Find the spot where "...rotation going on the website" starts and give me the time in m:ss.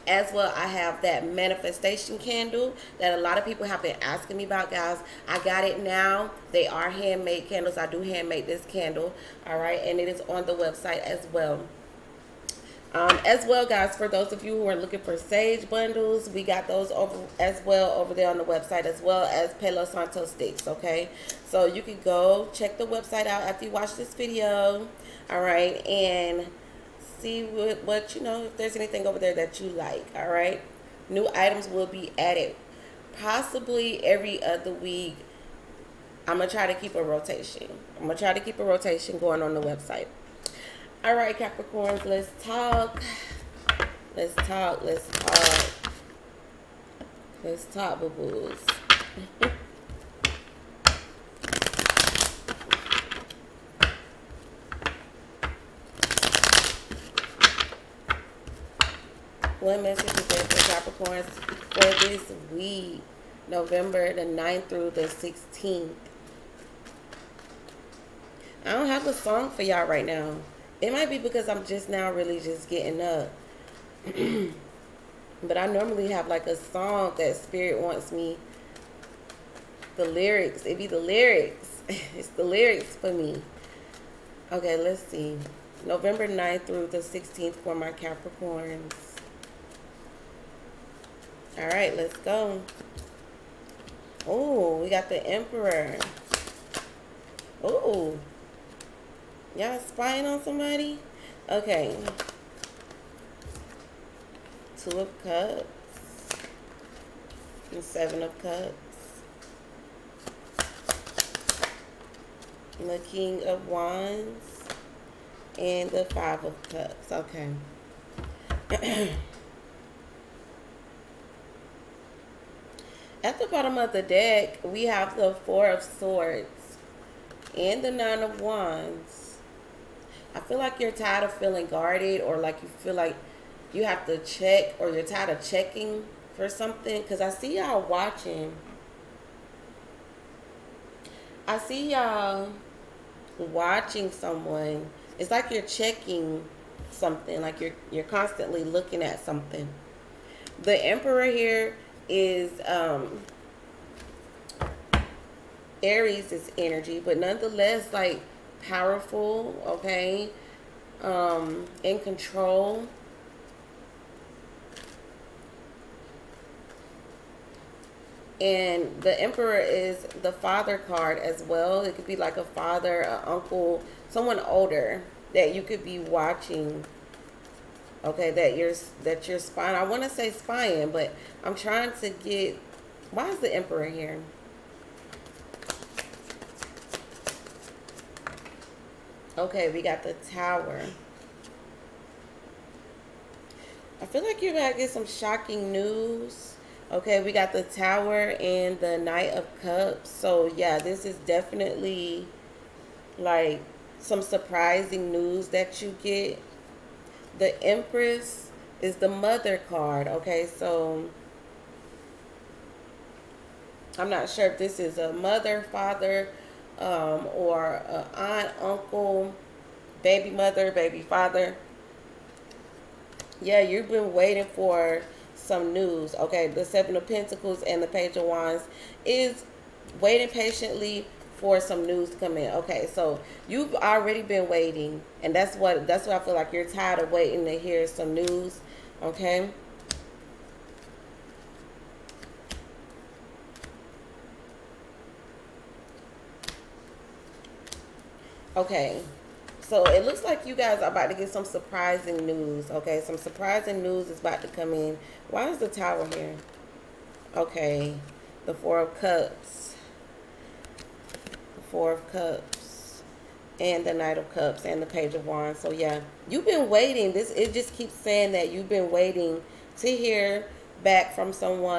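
0:38.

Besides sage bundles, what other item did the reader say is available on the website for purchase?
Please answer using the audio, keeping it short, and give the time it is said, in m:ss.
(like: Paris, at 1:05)
palo santo sticks, at 0:19.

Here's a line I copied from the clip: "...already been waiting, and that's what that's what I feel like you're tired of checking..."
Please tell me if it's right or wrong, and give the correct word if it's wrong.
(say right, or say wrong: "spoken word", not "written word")
wrong: "waiting", not "checking".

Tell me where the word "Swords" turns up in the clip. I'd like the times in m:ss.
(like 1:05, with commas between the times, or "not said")
2:05.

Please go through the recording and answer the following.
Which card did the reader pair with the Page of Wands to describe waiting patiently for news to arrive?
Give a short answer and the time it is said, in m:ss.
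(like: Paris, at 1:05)
Seven of Pentacles, at 3:46.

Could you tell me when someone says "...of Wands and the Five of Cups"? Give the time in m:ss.
1:53.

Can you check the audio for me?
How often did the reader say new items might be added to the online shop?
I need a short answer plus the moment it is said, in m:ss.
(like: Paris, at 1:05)
every other week, at 0:34.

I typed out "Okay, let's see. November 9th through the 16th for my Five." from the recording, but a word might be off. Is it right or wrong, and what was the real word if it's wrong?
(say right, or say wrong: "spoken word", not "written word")
wrong: "Capricorns", not "Five".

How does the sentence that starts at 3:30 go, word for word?
Okay, so I'm not sure if this is a mother, father, um, or aunt, uncle, baby mother, baby father.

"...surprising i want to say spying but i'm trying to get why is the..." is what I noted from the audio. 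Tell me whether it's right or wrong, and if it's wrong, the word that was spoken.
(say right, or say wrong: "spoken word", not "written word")
wrong: "spying", not "surprising".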